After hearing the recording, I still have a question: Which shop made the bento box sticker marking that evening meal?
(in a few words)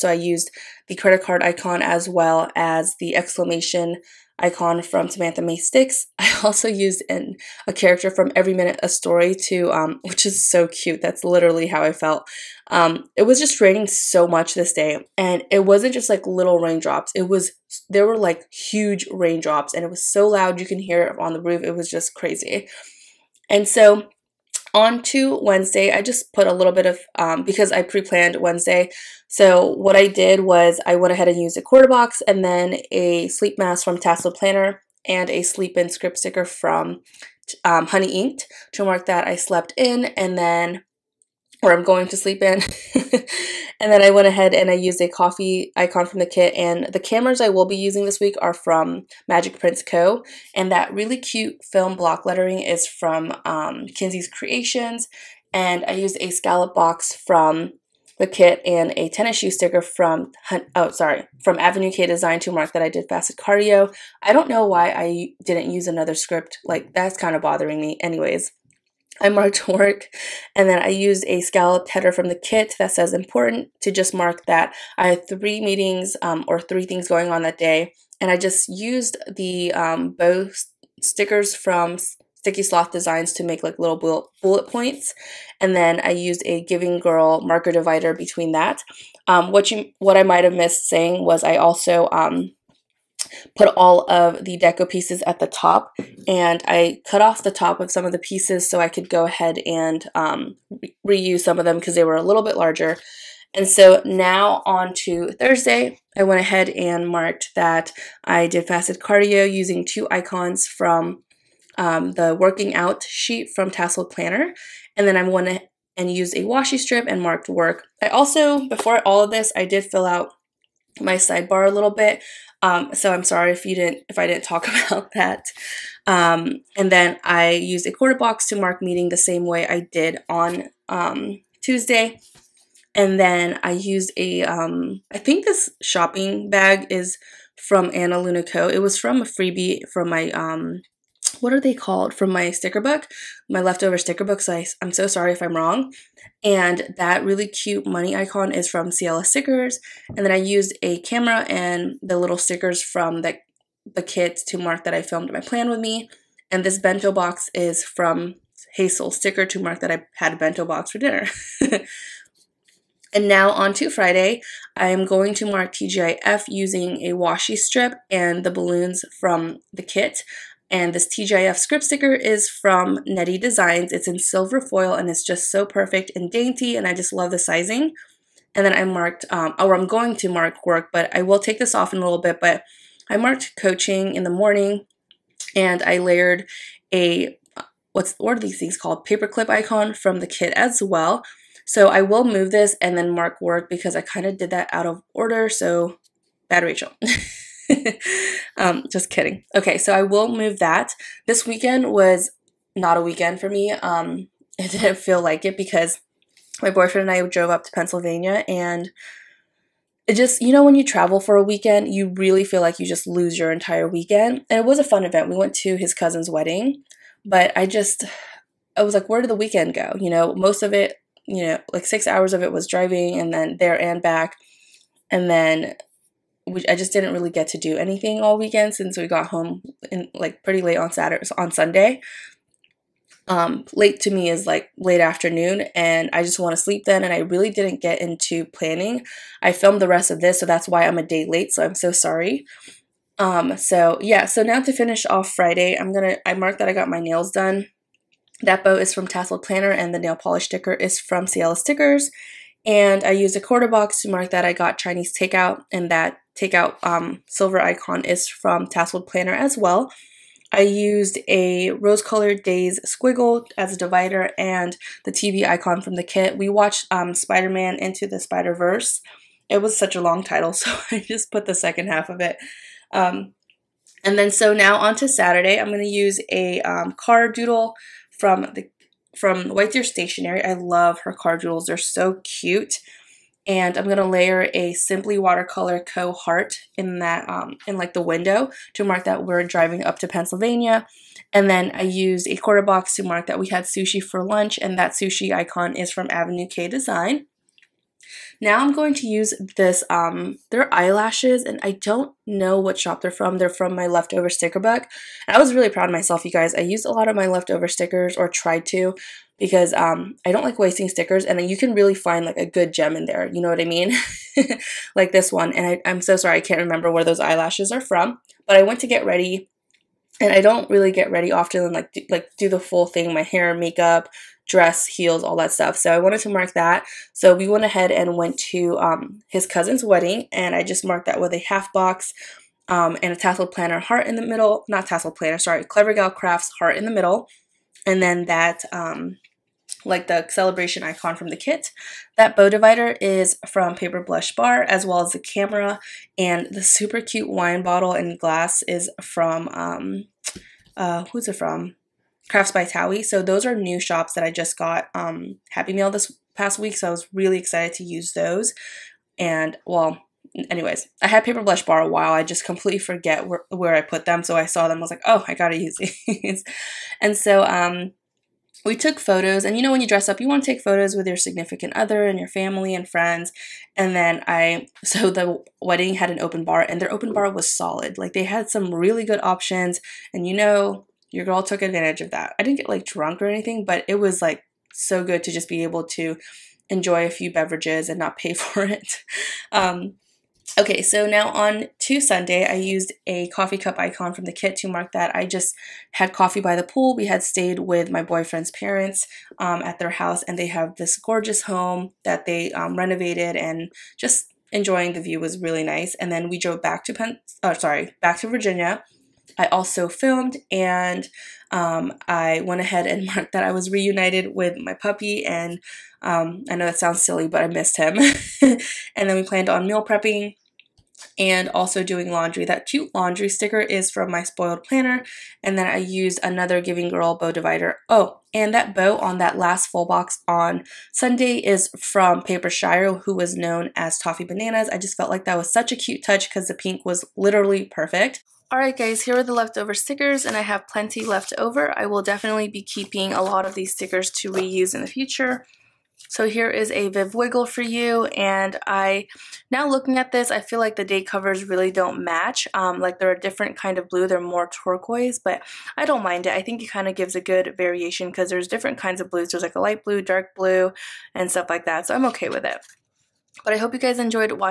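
Hazel Sticker.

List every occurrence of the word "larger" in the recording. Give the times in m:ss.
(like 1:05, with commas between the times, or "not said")
1:42.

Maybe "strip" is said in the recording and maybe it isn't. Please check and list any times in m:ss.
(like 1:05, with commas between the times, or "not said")
1:56, 2:47.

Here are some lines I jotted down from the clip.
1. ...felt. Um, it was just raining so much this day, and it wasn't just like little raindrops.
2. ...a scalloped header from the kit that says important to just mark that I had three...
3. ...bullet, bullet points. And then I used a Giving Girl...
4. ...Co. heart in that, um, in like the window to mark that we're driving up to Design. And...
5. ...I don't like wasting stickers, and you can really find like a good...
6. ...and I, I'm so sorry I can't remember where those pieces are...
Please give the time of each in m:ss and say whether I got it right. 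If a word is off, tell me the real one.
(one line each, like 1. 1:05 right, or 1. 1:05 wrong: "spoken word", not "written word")
1. 0:11 right
2. 1:11 right
3. 1:23 right
4. 4:45 wrong: "Pennsylvania", not "Design"
5. 5:10 right
6. 5:15 wrong: "eyelashes", not "pieces".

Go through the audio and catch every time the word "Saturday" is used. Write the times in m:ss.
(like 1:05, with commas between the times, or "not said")
3:50, 4:35.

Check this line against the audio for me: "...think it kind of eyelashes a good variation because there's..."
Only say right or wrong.
wrong.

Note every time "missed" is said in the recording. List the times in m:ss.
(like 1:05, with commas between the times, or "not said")
1:30, 6:57.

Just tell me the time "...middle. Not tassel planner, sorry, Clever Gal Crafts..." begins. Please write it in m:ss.
5:34.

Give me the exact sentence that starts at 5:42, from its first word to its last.
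That bow divider is from Paper Blush Bar, as well as the camera.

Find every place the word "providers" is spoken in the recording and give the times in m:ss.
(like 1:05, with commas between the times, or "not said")
not said.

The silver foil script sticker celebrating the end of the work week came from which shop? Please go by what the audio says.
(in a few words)
Nedi Designs.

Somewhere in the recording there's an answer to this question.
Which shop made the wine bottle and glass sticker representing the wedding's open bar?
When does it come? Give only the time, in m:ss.
5:52.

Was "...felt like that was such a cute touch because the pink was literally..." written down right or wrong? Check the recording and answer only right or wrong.
right.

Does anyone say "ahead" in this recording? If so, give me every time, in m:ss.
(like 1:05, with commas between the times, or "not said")
0:31, 0:44, 1:39, 1:46, 5:27, 6:52.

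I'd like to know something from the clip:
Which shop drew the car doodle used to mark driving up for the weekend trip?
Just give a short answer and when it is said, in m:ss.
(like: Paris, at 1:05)
White Deer Stationery, at 4:39.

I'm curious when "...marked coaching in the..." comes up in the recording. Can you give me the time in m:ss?
3:03.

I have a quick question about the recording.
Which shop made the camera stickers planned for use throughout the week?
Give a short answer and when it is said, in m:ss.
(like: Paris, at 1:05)
Magic Prince Co., at 0:49.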